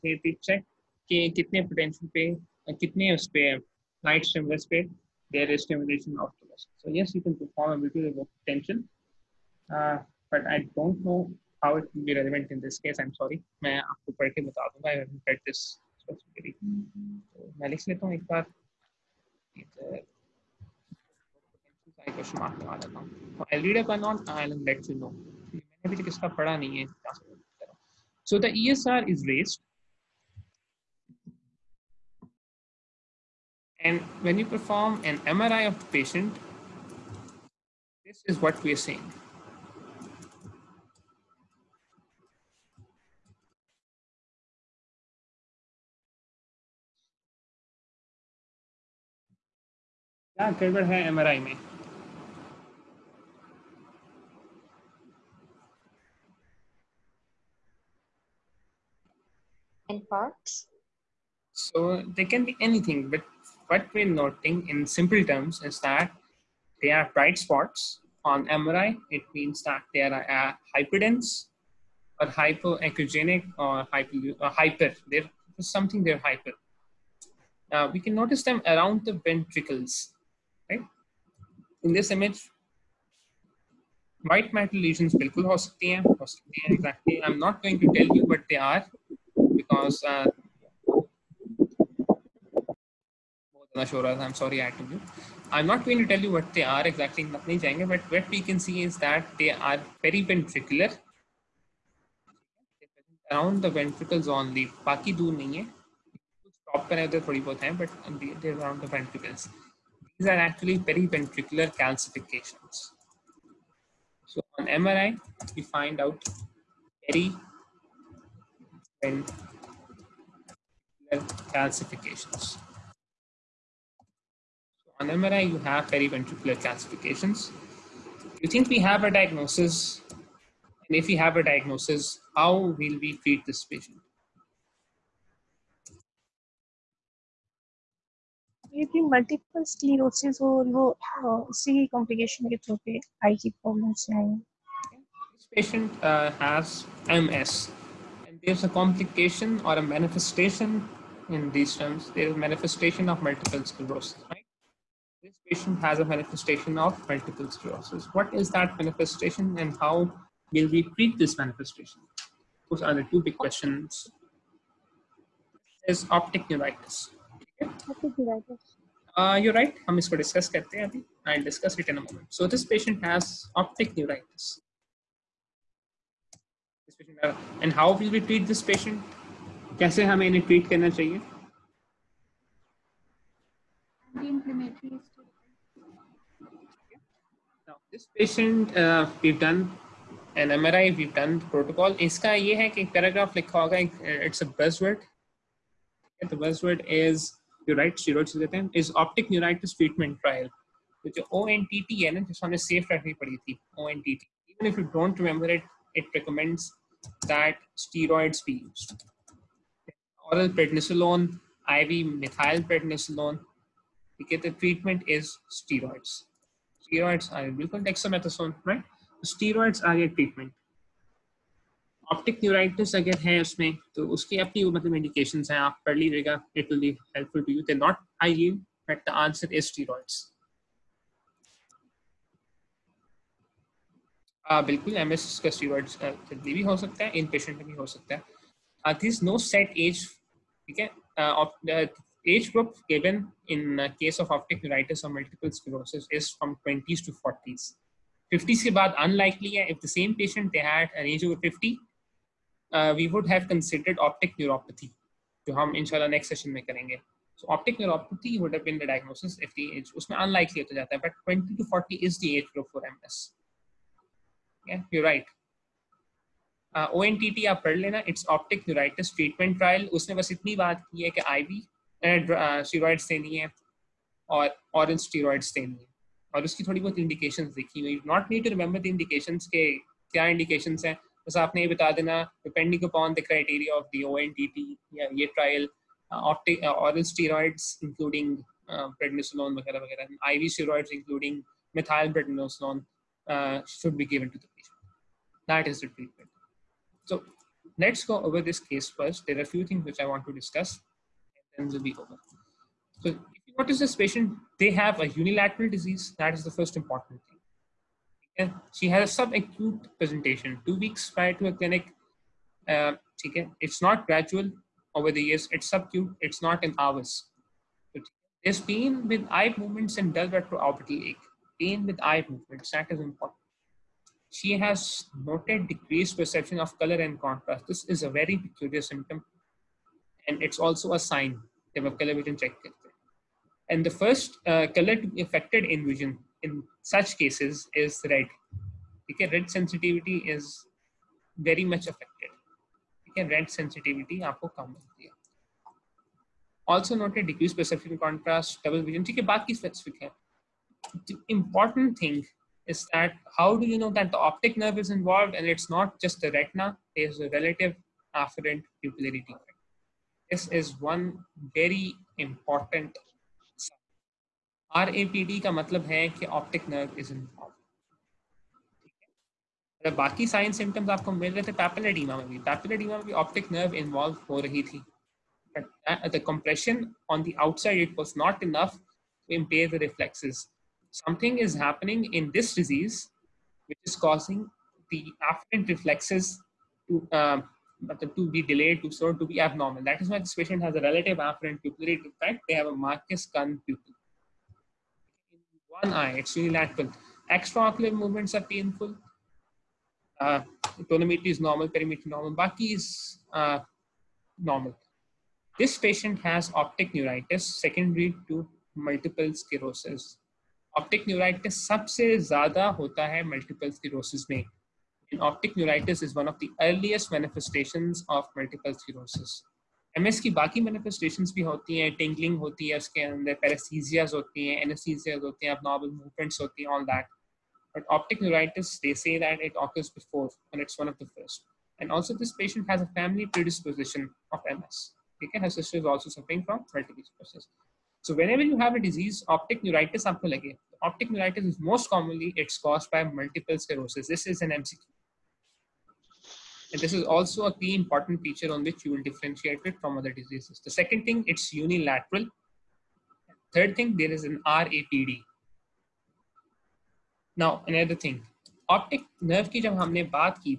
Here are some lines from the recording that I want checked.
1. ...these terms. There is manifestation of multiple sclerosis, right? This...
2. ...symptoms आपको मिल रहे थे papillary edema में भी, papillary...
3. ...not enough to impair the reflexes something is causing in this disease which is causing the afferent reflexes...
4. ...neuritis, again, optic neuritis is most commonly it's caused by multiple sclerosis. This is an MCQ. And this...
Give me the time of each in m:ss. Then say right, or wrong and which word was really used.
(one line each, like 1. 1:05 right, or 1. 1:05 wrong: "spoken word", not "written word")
1. 2:31 right
2. 6:10 right
3. 6:18 wrong: "happening", not "causing"
4. 7:19 right.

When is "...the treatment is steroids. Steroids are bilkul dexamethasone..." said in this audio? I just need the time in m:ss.
3:34.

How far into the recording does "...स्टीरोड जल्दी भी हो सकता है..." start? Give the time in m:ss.
3:55.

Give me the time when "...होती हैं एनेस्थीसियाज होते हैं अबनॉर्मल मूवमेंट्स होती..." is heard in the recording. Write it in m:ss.
7:04.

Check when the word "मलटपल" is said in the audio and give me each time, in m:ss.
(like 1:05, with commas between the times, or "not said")
2:19, 4:05, 6:53, 6:58, 7:16.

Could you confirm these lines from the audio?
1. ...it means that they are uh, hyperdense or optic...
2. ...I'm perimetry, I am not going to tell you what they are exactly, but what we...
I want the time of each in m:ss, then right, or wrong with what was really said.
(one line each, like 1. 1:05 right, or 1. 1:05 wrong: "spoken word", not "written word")
1. 1:09 wrong: "hypoechogenic", not "optic"
2. 1:33 wrong: "sorry", not "perimetry".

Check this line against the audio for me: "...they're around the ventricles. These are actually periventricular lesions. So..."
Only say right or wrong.
wrong.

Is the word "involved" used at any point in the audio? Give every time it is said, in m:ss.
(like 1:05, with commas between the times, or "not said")
5:54, 6:07, 6:13.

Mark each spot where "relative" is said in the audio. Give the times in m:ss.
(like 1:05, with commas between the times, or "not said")
5:57, 6:30.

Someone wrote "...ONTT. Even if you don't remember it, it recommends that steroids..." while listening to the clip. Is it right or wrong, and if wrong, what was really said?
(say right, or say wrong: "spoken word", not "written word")
right.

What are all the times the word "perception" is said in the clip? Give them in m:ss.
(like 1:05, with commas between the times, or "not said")
5:26, 5:47.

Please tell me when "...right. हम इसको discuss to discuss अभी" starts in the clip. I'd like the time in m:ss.
2:49.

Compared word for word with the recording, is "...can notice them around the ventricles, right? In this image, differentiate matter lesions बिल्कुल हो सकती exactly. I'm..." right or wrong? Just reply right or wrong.
wrong.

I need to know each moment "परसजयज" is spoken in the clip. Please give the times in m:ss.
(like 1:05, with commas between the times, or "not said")
7:03.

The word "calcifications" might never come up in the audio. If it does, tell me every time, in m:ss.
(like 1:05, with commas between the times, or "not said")
1:51, 2:01, 2:06.